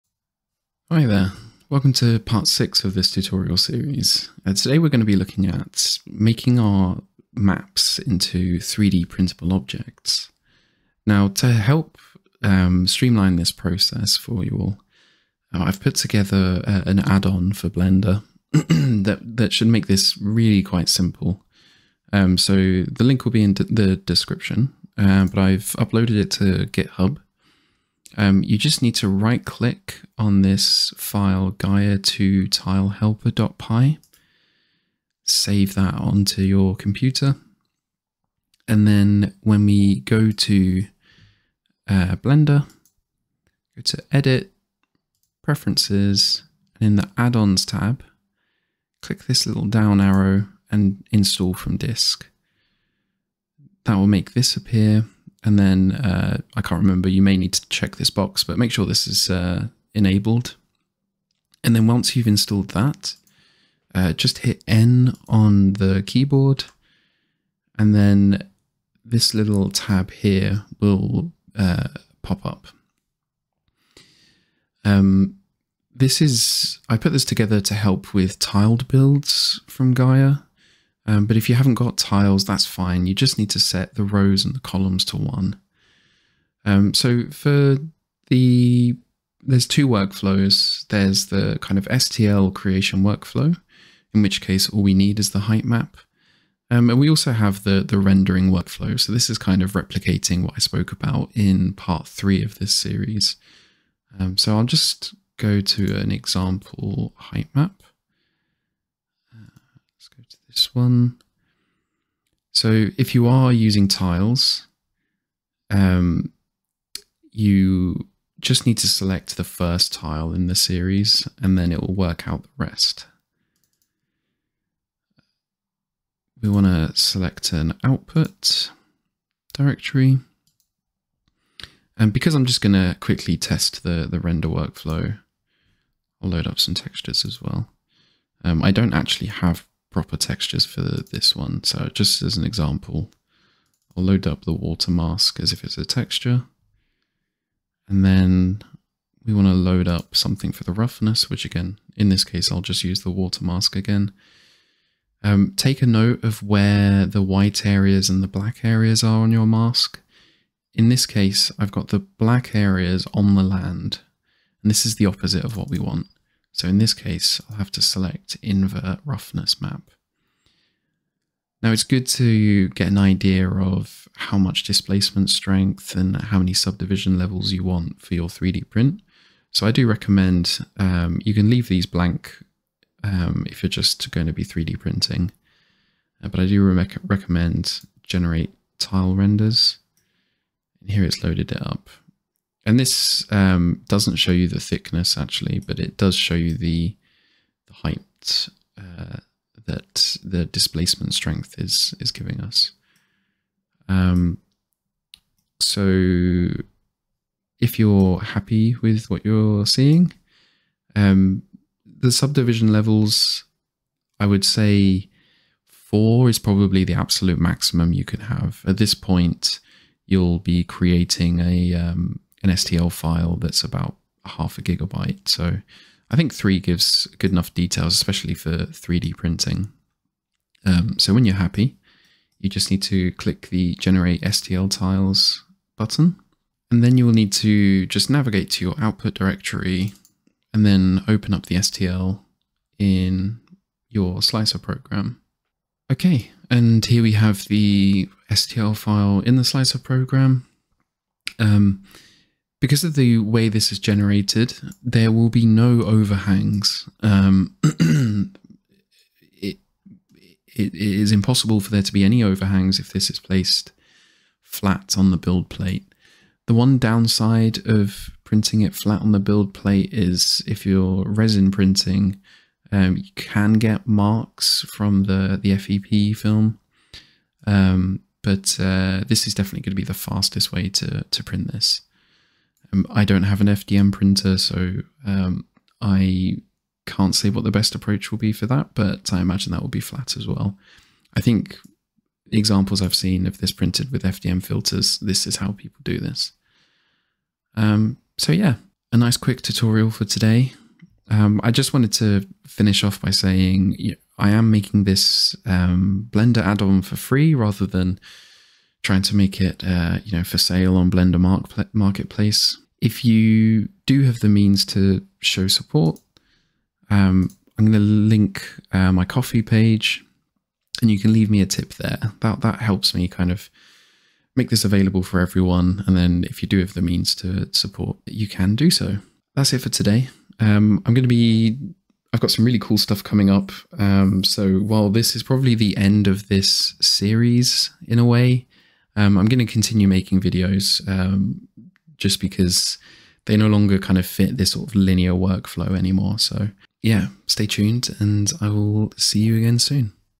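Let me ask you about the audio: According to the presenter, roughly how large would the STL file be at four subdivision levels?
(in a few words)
half a gigabyte.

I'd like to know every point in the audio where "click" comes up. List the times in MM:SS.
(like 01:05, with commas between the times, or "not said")
00:29, 00:49, 03:53.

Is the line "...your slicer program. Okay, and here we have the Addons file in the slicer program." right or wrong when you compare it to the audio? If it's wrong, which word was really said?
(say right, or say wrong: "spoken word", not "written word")
wrong: "STL", not "Addons".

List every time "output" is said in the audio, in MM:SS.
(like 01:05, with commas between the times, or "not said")
02:07, 03:58.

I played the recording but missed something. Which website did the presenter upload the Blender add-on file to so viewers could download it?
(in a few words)
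GitHub.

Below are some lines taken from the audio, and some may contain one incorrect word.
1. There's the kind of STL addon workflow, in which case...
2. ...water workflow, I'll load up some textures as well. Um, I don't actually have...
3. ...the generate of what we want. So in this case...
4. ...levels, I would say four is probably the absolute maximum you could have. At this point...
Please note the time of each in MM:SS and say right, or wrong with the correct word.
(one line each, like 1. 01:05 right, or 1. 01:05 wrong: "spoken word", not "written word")
1. 01:30 wrong: "creation", not "addon"
2. 02:14 wrong: "render", not "water"
3. 02:44 wrong: "opposite", not "generate"
4. 03:32 right.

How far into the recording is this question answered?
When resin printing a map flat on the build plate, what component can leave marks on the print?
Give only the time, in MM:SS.
04:35.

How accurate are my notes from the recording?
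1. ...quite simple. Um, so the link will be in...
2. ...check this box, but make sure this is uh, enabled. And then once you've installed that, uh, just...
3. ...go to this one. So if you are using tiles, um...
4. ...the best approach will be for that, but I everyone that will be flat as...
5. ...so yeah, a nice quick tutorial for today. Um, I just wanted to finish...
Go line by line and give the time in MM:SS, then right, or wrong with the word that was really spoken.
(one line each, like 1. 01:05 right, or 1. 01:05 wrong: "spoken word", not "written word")
1. 00:20 right
2. 00:57 right
3. 01:50 right
4. 04:47 wrong: "imagine", not "everyone"
5. 04:58 right.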